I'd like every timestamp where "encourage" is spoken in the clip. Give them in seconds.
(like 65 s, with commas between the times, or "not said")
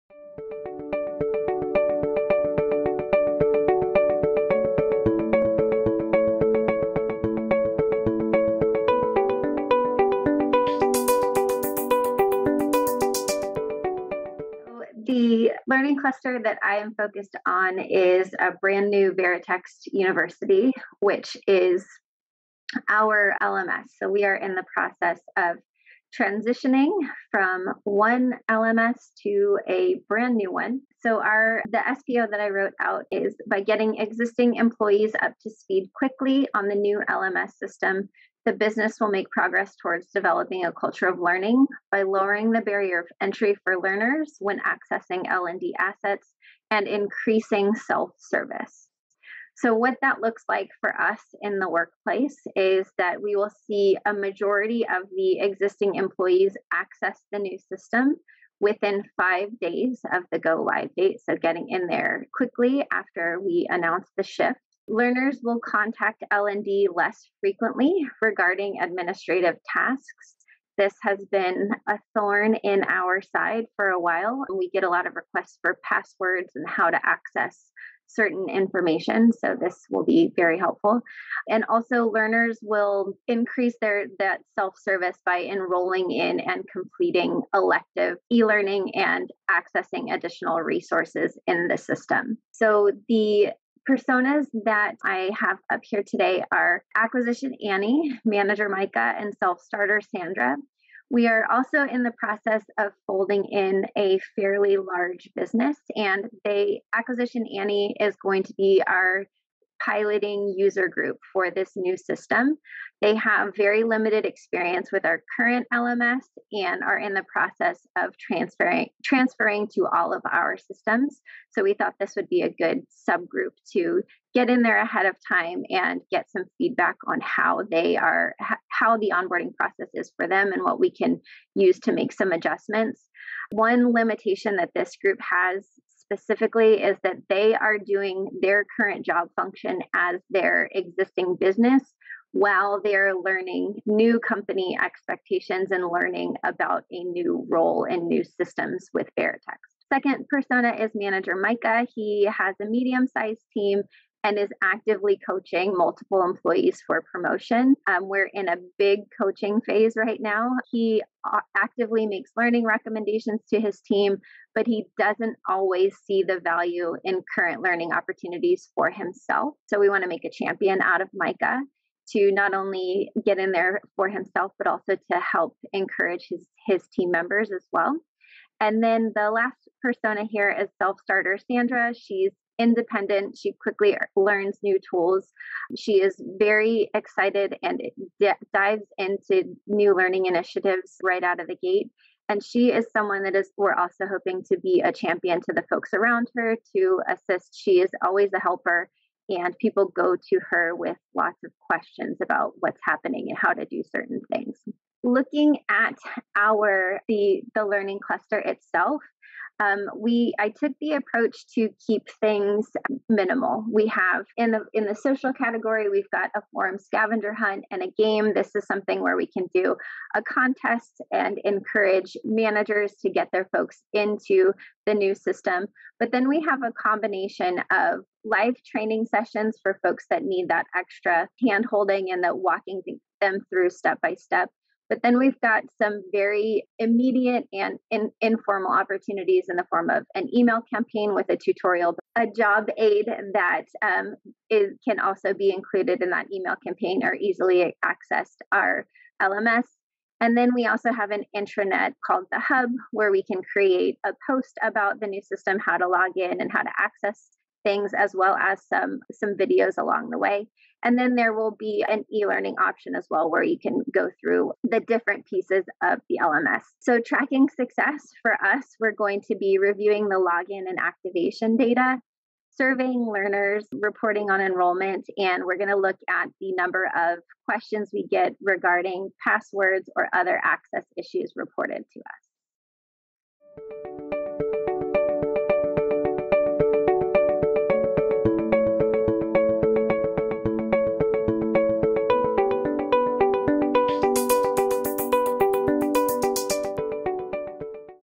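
175 s, 221 s.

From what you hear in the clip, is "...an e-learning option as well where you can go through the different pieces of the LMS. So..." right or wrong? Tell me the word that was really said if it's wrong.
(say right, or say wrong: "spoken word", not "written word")
right.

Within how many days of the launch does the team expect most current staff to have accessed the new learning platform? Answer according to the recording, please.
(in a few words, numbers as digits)
5 days.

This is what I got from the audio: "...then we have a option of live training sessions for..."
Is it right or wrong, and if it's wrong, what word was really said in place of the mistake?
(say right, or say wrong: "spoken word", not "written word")
wrong: "combination", not "option".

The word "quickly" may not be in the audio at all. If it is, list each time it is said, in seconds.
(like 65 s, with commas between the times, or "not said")
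35 s, 62 s, 183 s.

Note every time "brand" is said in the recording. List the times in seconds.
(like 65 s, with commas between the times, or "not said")
18 s, 30 s.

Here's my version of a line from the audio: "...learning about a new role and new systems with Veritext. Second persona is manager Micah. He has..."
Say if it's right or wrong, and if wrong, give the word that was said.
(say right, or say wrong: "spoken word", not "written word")
right.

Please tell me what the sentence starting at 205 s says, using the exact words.
Looking at our the the learning cluster itself, um, we I took the approach to keep things minimal.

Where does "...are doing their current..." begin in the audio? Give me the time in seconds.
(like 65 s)
137 s.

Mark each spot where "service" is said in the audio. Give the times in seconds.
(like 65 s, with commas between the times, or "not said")
47 s, 84 s.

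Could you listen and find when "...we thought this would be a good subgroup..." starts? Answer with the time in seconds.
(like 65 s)
121 s.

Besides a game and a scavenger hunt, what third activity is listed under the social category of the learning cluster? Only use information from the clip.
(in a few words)
forum.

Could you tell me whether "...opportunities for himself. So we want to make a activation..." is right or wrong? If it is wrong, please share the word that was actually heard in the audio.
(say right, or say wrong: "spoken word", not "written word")
wrong: "champion", not "activation".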